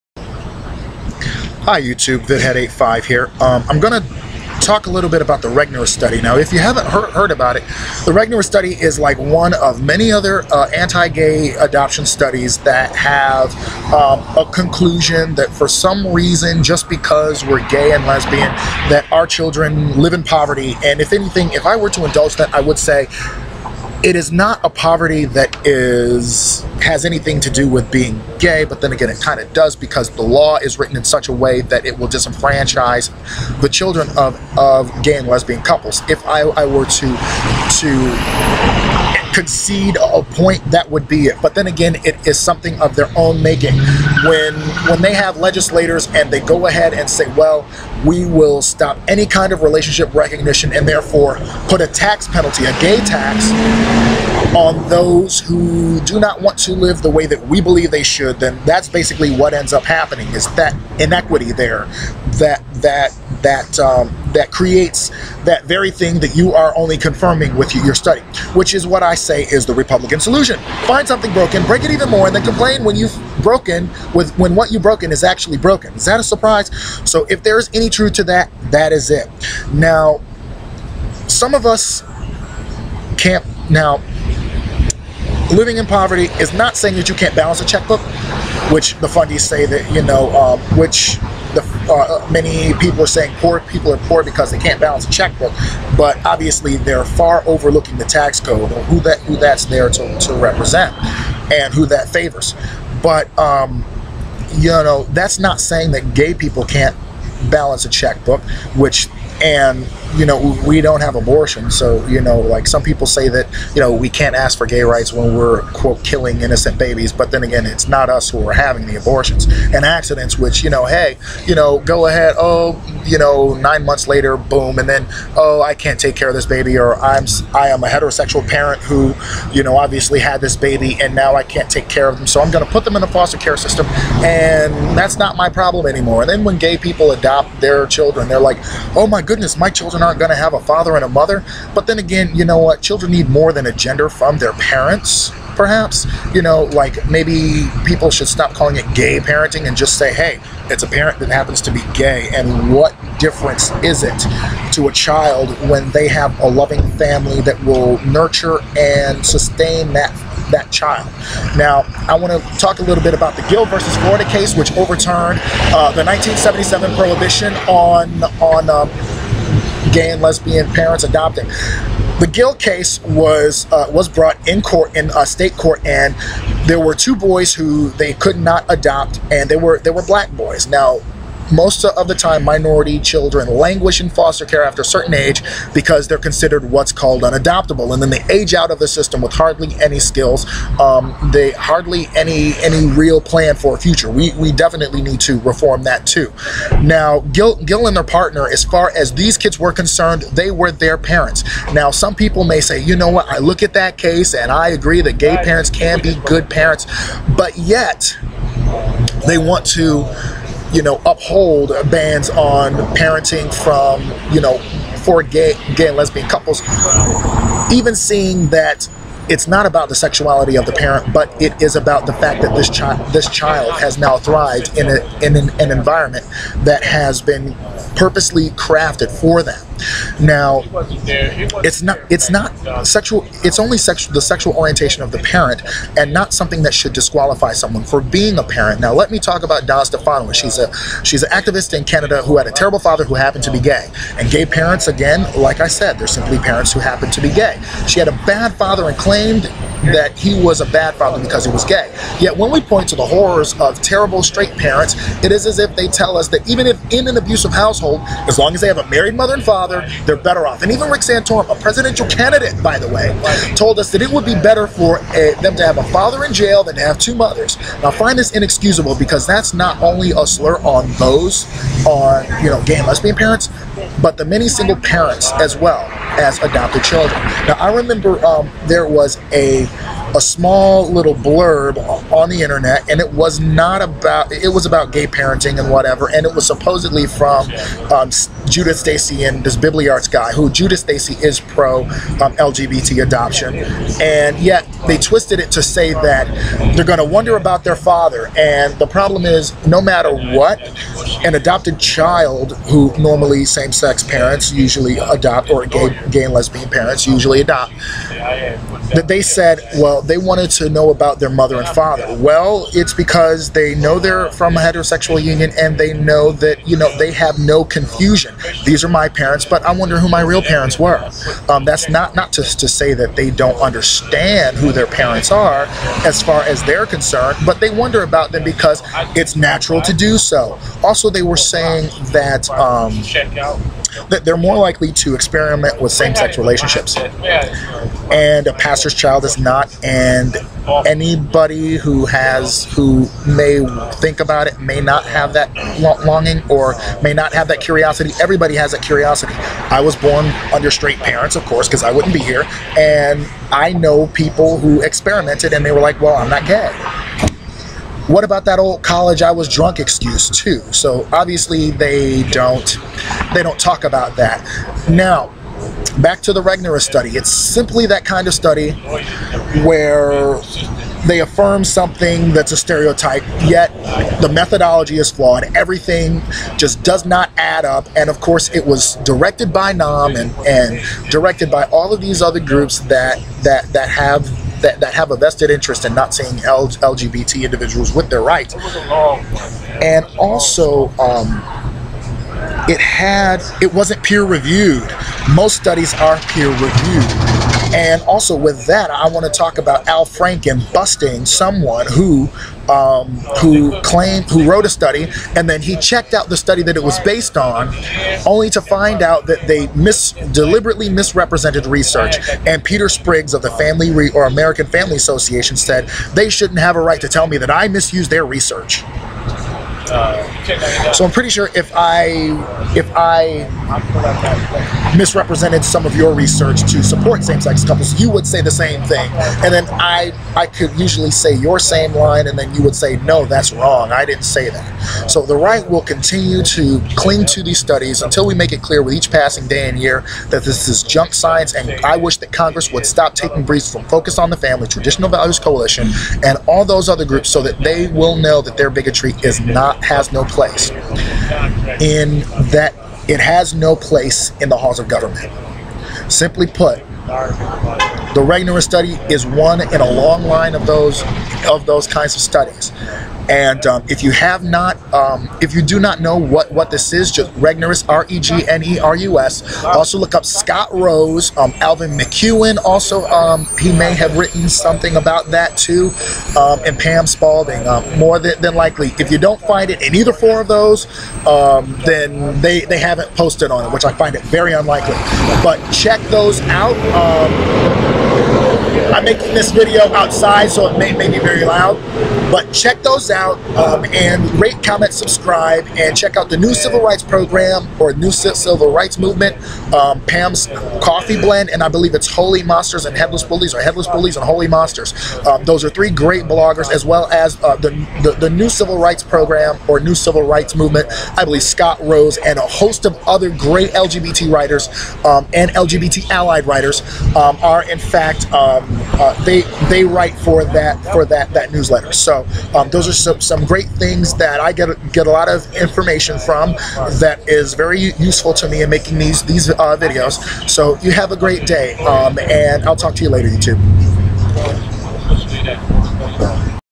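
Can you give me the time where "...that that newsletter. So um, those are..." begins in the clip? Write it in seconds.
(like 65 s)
521 s.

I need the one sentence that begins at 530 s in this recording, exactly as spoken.
So you have a great day, um, and I'll talk to you later, YouTube.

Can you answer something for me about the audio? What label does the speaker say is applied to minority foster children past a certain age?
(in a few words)
unadoptable.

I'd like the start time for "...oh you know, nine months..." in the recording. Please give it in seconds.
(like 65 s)
122 s.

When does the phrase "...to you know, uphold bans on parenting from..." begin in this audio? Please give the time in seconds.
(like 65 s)
209 s.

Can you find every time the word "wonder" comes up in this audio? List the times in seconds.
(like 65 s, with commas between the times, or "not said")
297 s, 319 s, 327 s.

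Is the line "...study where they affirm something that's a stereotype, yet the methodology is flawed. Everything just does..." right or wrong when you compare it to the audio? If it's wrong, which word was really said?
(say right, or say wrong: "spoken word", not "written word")
right.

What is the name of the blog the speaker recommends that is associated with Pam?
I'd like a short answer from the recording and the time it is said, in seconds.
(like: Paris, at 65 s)
Pam's Coffee Blend, at 500 s.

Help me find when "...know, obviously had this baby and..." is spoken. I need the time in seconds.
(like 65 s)
129 s.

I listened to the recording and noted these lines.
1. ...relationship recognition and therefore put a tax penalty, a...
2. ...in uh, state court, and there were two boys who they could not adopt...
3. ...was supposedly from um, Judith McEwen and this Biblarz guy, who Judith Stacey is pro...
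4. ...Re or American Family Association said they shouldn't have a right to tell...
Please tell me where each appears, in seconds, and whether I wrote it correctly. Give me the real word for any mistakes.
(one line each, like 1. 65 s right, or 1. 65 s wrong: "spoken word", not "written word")
1. 49 s right
2. 174 s right
3. 286 s wrong: "Stacey", not "McEwen"
4. 413 s right.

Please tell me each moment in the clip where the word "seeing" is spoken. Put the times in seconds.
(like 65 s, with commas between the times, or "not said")
217 s, 386 s.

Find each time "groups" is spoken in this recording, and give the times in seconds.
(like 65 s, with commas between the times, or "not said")
382 s, 447 s.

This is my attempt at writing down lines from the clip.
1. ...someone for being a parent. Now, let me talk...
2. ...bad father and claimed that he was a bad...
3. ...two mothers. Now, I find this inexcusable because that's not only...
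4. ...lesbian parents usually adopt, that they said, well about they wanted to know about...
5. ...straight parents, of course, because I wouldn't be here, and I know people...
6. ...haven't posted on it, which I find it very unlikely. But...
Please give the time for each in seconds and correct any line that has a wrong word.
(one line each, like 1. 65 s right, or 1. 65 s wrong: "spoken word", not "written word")
1. 237 s right
2. 248 s right
3. 266 s right
4. 306 s right
5. 350 s right
6. 482 s right.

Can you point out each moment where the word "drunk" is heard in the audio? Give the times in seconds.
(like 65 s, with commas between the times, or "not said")
359 s.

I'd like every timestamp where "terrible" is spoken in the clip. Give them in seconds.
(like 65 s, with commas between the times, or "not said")
242 s, 253 s.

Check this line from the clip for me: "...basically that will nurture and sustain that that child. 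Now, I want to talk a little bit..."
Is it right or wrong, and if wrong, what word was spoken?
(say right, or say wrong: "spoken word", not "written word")
wrong: "family", not "basically".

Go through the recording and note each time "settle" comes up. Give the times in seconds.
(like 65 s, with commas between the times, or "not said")
not said.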